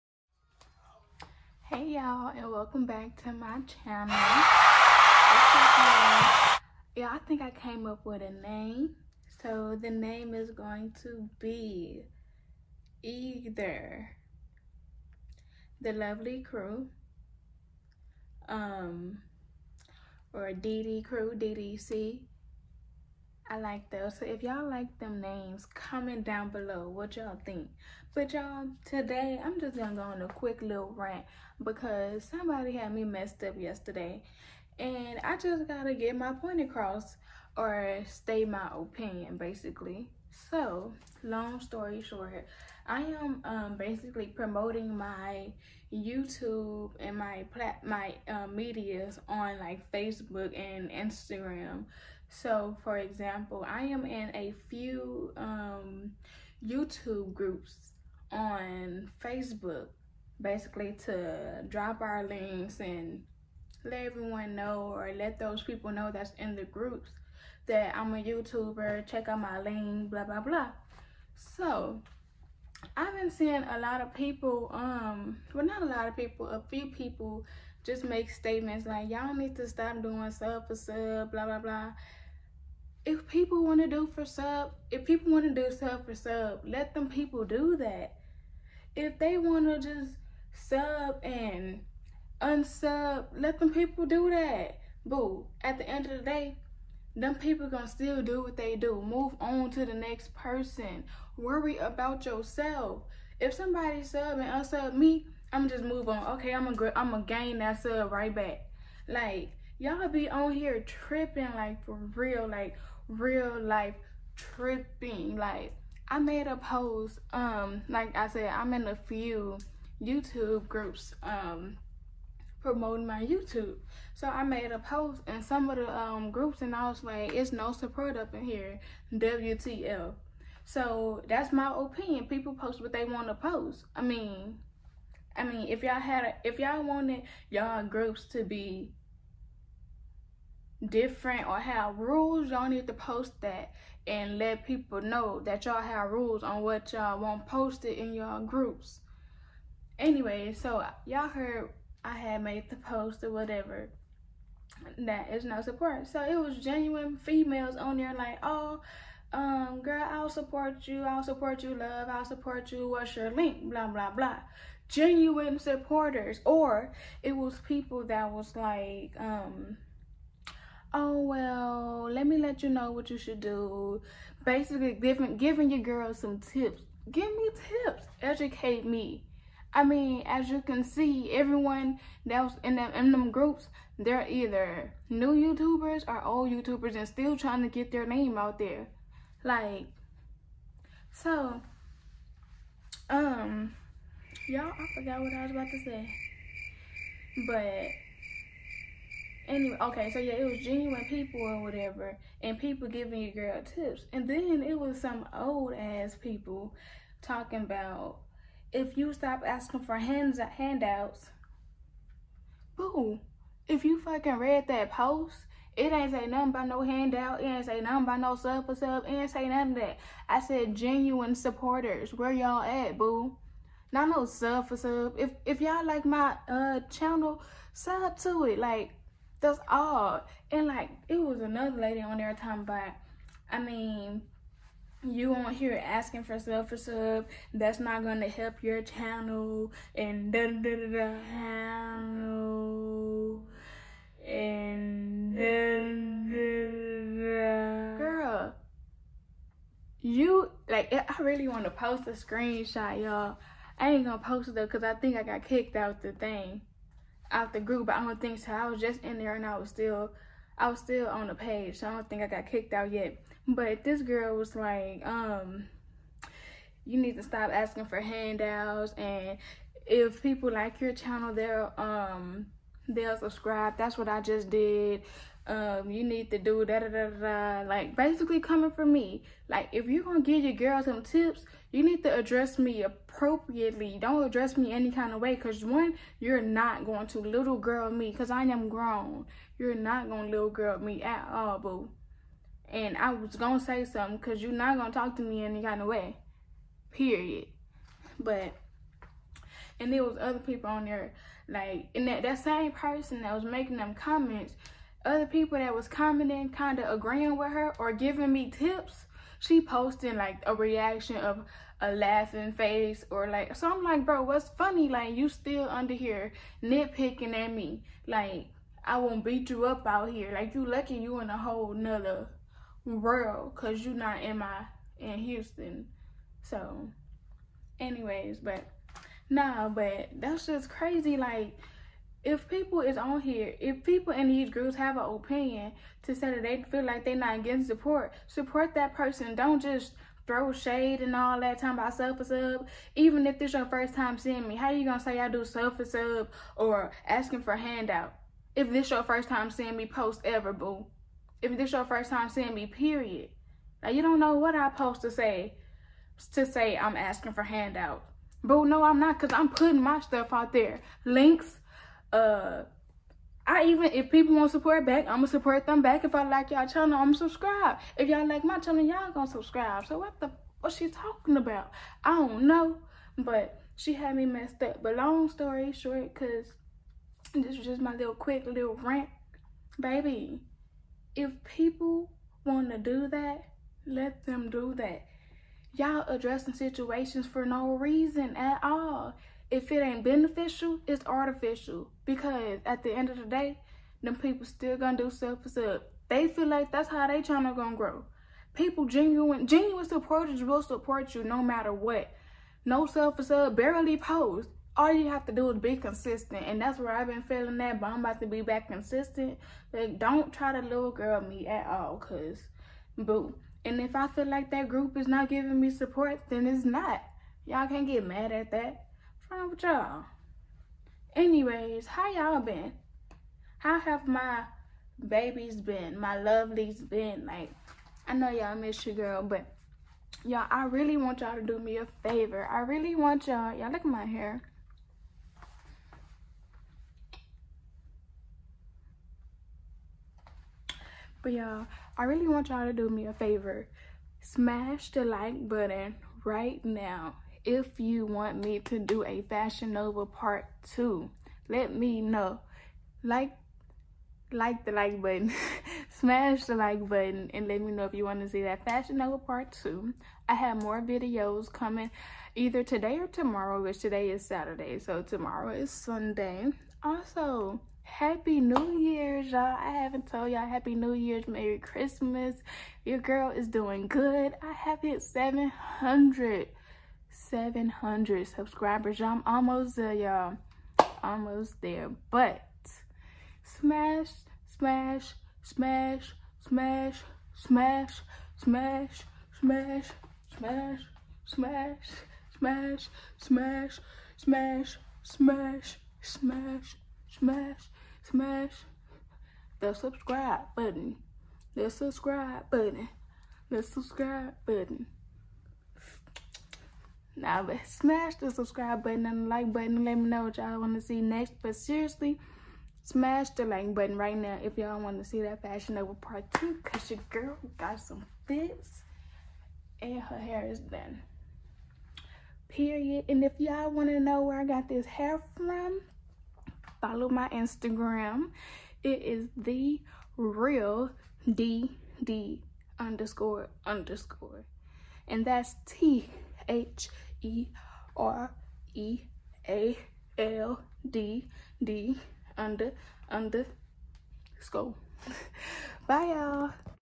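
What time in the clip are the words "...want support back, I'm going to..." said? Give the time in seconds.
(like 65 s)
364 s.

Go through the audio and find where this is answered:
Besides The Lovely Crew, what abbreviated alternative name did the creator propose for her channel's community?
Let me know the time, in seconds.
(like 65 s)
21 s.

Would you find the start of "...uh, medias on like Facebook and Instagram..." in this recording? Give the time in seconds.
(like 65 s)
48 s.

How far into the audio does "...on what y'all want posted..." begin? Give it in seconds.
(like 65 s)
146 s.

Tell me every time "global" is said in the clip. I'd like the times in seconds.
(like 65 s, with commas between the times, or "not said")
not said.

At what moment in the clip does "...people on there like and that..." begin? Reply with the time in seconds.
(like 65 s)
300 s.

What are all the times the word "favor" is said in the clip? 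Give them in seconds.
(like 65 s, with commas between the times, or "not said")
432 s, 443 s.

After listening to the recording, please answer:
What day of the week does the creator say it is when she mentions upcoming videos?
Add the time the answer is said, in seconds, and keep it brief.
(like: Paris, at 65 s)
Saturday, at 464 s.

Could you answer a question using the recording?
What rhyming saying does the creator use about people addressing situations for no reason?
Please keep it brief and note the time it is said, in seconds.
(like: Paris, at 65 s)
If it ain't beneficial, it's artificial, at 389 s.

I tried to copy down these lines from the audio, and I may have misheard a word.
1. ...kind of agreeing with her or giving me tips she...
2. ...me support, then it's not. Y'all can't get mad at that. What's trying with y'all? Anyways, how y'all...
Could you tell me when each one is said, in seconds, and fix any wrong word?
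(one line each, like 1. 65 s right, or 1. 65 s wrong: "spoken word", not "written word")
1. 306 s right
2. 415 s wrong: "wrong", not "trying".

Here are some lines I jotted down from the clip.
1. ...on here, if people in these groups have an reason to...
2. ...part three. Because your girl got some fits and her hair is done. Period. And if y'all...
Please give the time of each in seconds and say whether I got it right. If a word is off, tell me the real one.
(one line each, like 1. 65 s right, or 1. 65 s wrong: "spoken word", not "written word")
1. 332 s wrong: "opinion", not "reason"
2. 515 s wrong: "two", not "three".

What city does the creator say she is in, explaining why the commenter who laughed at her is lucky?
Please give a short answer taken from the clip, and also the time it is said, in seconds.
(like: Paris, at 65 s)
Houston, at 325 s.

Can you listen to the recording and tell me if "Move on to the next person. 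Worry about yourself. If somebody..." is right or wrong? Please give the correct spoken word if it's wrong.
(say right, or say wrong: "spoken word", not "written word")
right.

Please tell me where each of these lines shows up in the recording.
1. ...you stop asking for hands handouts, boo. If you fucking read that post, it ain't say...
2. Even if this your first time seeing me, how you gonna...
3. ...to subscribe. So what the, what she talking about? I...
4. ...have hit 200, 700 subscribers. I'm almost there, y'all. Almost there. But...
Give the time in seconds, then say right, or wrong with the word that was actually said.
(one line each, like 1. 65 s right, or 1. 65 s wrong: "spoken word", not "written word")
1. 208 s right
2. 342 s right
3. 369 s right
4. 474 s wrong: "700", not "200".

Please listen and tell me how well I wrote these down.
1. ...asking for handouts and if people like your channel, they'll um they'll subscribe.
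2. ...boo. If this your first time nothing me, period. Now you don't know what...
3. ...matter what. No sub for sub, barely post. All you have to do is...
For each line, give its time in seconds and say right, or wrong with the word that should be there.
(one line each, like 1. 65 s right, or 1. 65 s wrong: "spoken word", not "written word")
1. 267 s right
2. 350 s wrong: "seeing", not "nothing"
3. 401 s right.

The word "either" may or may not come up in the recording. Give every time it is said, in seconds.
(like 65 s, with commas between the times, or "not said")
13 s, 184 s, 462 s.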